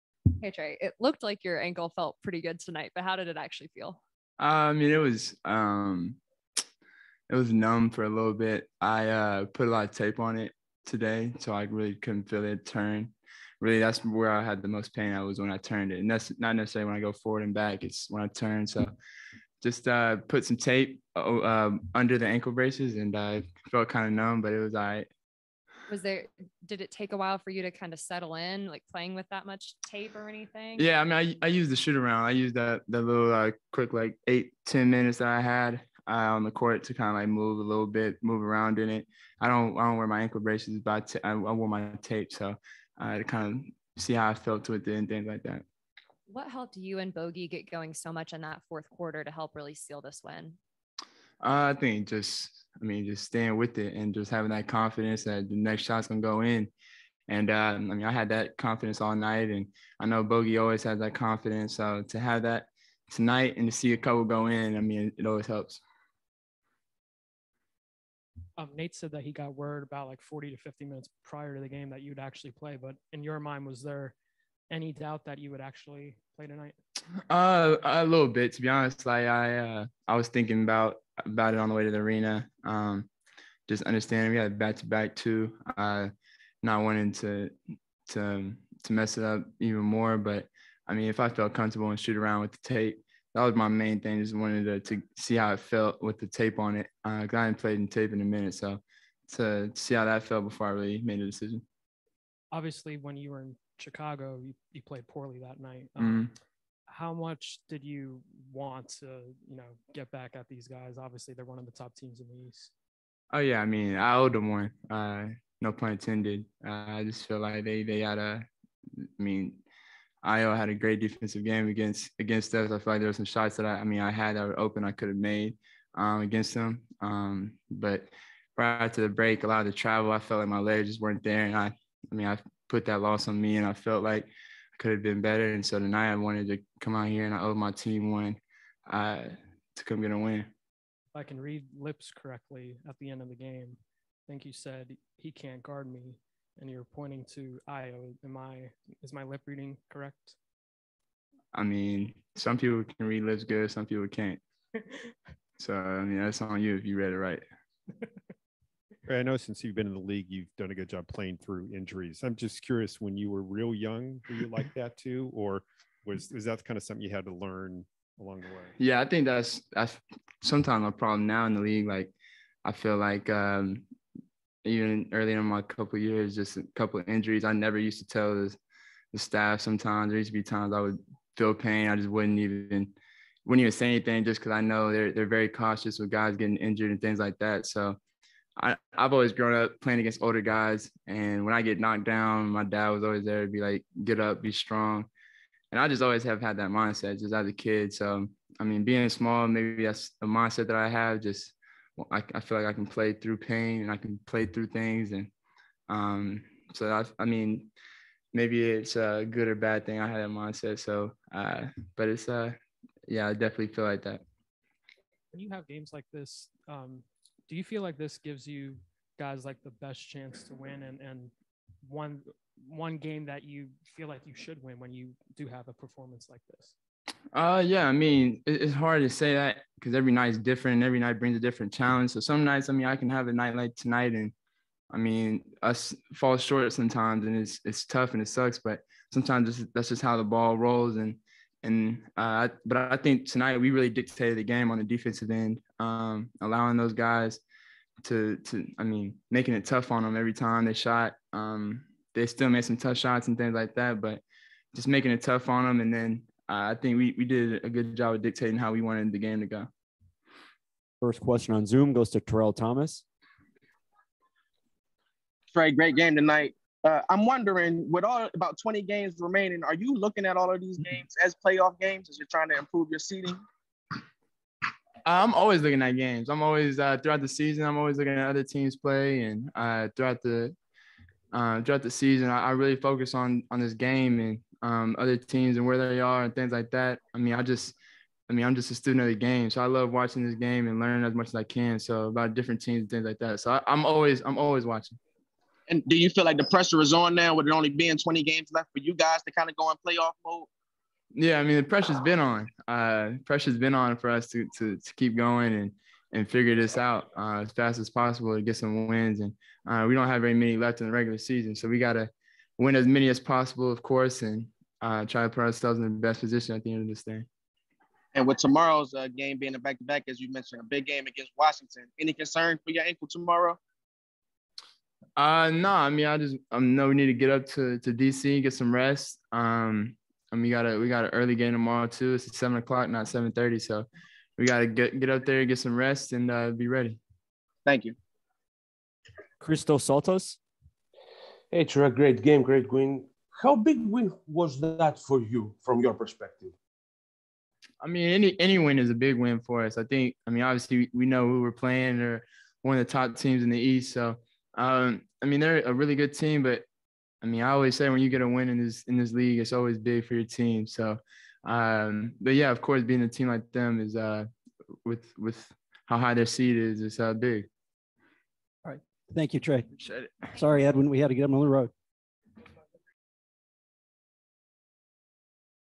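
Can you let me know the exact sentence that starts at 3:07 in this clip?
So I, I've always grown up playing against older guys.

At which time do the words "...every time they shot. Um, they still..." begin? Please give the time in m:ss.
4:10.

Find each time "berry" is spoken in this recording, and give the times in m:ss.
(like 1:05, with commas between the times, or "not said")
not said.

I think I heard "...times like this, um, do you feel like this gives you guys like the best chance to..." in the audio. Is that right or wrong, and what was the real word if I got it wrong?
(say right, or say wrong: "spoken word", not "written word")
wrong: "games", not "times".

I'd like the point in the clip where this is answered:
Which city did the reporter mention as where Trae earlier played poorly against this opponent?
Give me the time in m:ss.
1:43.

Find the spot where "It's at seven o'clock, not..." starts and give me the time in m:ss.
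5:32.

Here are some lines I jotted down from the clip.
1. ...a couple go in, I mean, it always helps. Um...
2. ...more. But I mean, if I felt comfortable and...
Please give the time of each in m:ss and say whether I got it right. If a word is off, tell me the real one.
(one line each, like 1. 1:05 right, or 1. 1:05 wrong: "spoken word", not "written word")
1. 1:03 right
2. 1:29 right.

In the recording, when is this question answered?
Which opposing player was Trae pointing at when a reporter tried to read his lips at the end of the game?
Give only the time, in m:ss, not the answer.
2:27.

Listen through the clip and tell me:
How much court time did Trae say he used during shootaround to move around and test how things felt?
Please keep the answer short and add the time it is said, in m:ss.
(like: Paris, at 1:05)
8 to 10 minutes, at 0:34.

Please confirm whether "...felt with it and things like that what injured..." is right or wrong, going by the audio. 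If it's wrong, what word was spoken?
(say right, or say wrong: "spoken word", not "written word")
wrong: "helped", not "injured".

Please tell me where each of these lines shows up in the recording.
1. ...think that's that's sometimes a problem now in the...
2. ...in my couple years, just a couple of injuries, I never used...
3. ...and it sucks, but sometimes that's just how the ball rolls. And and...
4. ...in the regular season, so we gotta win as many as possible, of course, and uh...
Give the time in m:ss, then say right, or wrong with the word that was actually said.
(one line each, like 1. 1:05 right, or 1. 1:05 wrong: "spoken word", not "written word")
1. 2:49 right
2. 2:55 right
3. 3:58 right
4. 5:10 right.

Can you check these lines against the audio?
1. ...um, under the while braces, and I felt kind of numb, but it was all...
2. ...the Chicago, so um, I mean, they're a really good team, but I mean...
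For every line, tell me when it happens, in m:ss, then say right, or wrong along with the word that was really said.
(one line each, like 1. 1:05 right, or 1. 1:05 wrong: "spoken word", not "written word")
1. 0:21 wrong: "ankle", not "while"
2. 5:53 wrong: "East", not "Chicago".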